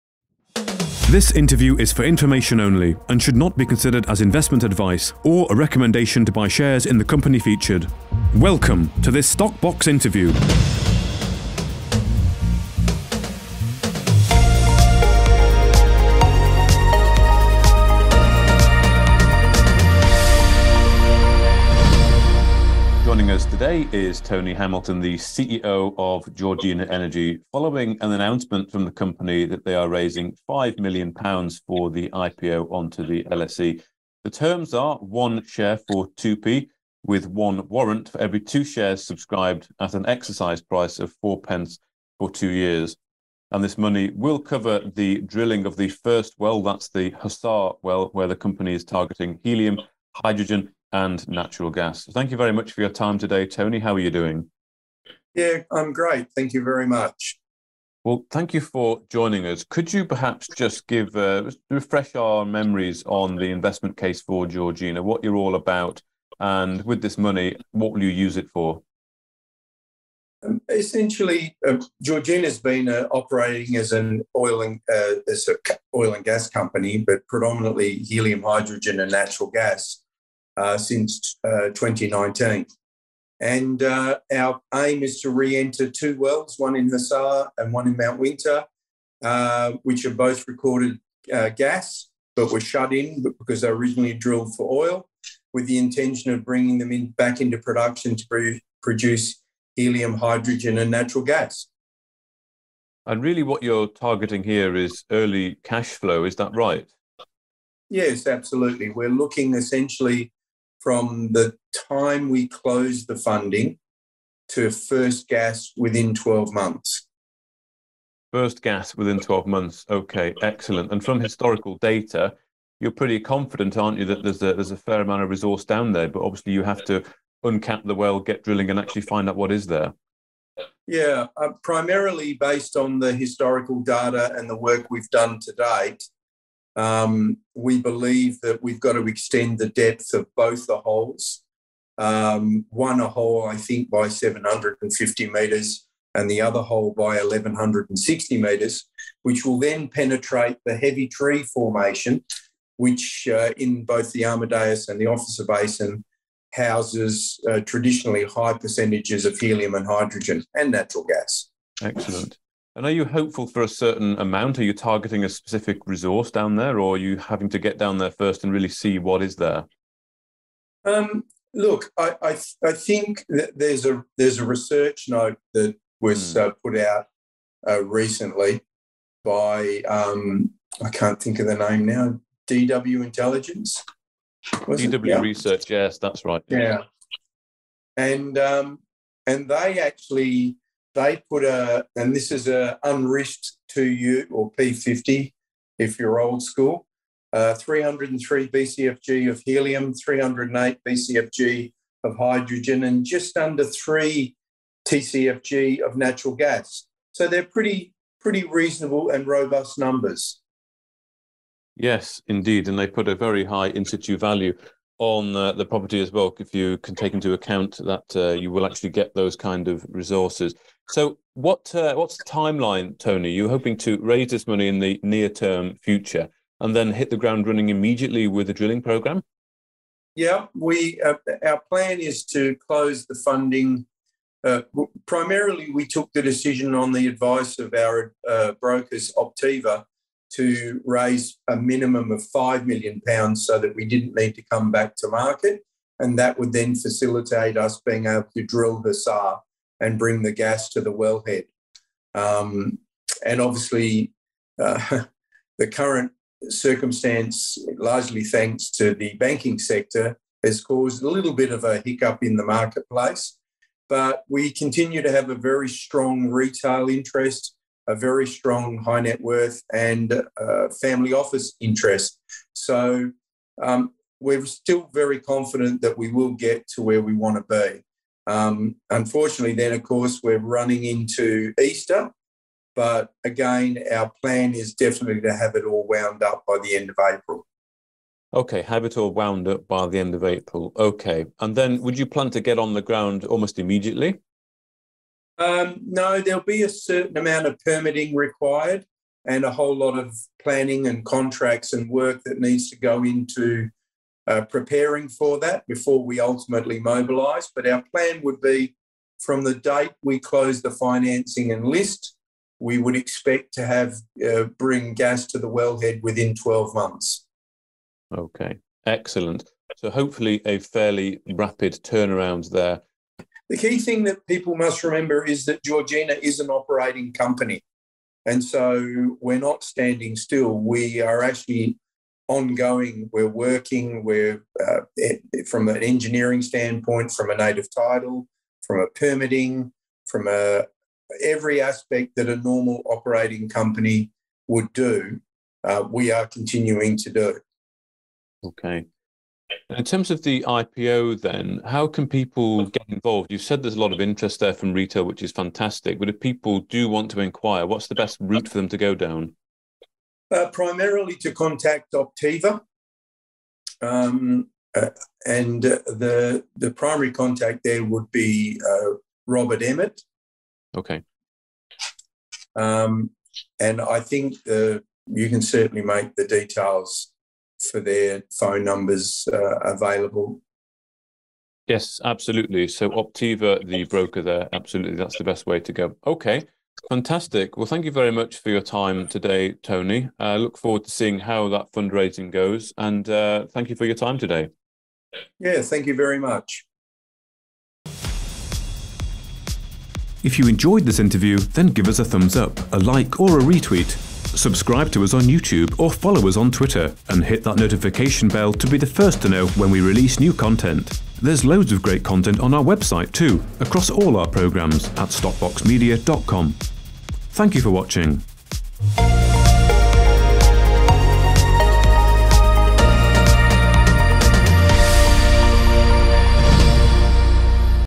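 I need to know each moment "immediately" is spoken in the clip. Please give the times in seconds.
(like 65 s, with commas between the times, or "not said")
227 s, 293 s.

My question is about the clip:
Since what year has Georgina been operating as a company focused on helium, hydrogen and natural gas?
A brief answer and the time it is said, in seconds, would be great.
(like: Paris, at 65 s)
2019, at 81 s.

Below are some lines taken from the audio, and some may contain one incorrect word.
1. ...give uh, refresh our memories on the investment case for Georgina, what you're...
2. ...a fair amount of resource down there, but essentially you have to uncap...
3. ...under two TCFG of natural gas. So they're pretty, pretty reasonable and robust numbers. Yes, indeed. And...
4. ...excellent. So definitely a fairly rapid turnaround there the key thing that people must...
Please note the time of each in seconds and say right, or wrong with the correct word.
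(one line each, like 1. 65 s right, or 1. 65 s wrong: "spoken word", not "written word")
1. 60 s right
2. 124 s wrong: "obviously", not "essentially"
3. 203 s wrong: "three", not "two"
4. 318 s wrong: "hopefully", not "definitely".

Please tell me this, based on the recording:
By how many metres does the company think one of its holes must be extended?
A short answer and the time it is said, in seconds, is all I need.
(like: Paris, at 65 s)
750 metres, at 144 s.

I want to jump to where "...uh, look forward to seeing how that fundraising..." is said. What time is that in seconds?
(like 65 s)
390 s.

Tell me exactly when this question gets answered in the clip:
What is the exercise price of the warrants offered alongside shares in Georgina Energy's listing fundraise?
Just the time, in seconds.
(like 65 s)
41 s.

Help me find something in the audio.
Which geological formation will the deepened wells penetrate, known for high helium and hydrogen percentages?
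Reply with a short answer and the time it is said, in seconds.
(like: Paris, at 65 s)
Heavitree formation, at 150 s.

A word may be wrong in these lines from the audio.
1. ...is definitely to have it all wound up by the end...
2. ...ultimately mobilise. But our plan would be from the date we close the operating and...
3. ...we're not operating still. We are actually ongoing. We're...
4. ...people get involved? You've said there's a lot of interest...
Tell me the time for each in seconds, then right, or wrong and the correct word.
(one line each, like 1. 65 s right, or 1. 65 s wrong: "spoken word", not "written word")
1. 284 s right
2. 306 s wrong: "financing", not "operating"
3. 329 s wrong: "standing", not "operating"
4. 352 s right.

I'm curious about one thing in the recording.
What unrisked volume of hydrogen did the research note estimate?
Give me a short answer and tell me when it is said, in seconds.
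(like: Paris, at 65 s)
308 BCFG, at 199 s.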